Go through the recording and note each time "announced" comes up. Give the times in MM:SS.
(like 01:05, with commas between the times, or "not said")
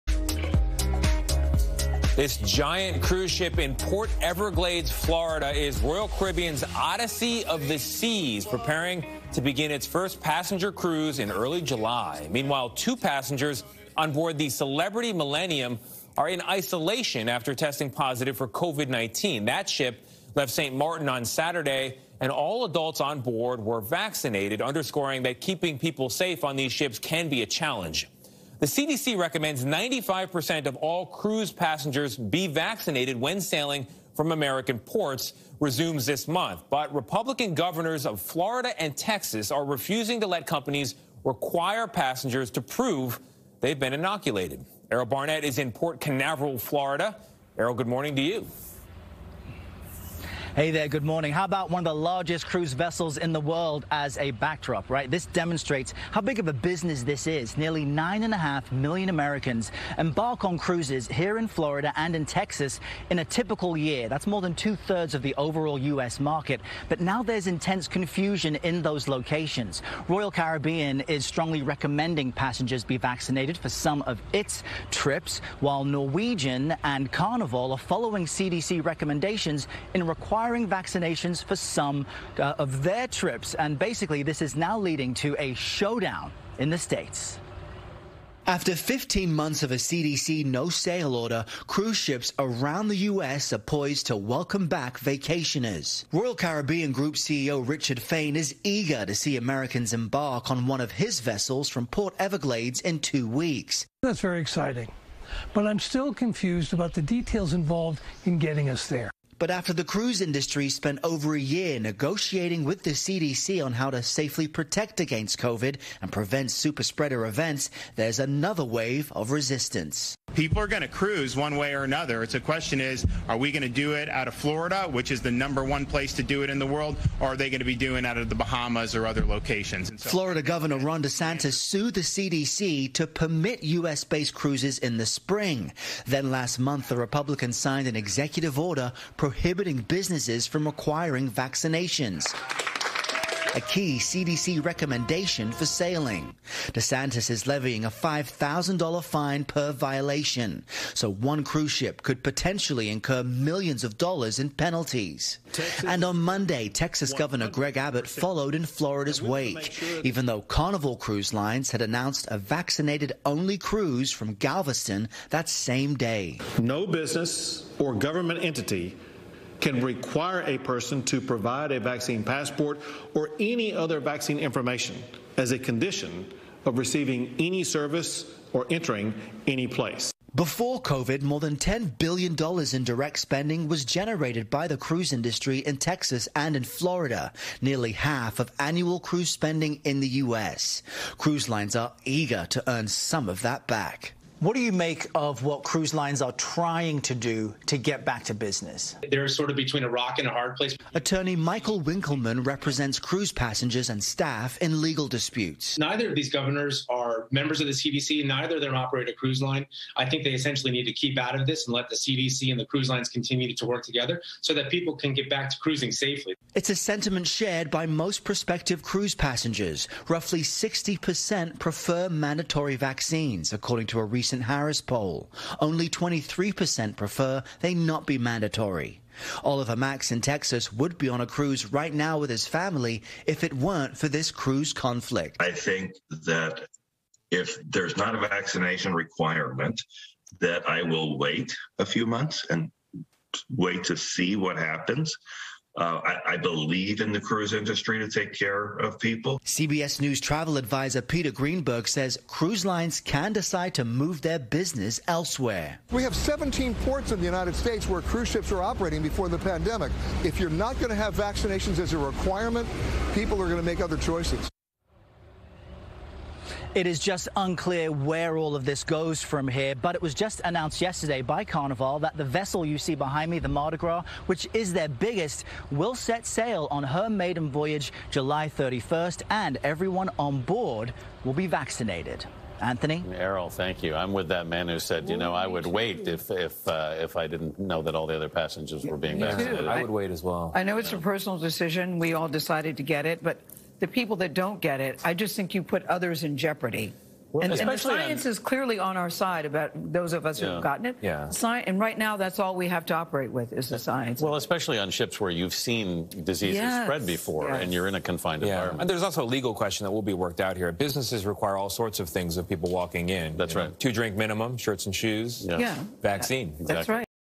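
02:41, 04:30.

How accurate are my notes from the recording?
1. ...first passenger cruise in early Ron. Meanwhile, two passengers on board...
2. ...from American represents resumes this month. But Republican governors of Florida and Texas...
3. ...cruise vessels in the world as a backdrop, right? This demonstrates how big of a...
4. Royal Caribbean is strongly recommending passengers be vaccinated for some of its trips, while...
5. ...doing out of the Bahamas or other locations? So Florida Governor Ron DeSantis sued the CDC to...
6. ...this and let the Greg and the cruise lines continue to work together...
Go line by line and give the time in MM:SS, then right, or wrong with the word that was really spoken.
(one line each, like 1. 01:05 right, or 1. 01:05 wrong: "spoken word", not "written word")
1. 00:09 wrong: "July", not "Ron"
2. 00:34 wrong: "ports", not "represents"
3. 00:52 right
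4. 01:10 right
5. 02:07 right
6. 03:31 wrong: "CDC", not "Greg".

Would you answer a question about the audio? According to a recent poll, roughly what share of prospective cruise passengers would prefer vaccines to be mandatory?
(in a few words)
60%.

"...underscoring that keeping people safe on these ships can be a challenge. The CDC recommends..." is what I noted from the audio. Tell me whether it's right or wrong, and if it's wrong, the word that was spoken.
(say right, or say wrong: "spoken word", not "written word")
right.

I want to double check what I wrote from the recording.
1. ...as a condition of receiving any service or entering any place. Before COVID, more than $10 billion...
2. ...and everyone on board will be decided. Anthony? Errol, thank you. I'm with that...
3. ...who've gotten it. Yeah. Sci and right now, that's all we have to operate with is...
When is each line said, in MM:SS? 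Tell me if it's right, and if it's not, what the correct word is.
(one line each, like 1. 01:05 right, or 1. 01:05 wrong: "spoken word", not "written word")
1. 02:55 right
2. 04:39 wrong: "vaccinated", not "decided"
3. 05:00 right.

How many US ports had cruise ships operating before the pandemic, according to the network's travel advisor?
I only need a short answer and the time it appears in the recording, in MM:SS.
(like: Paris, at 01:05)
17, at 04:16.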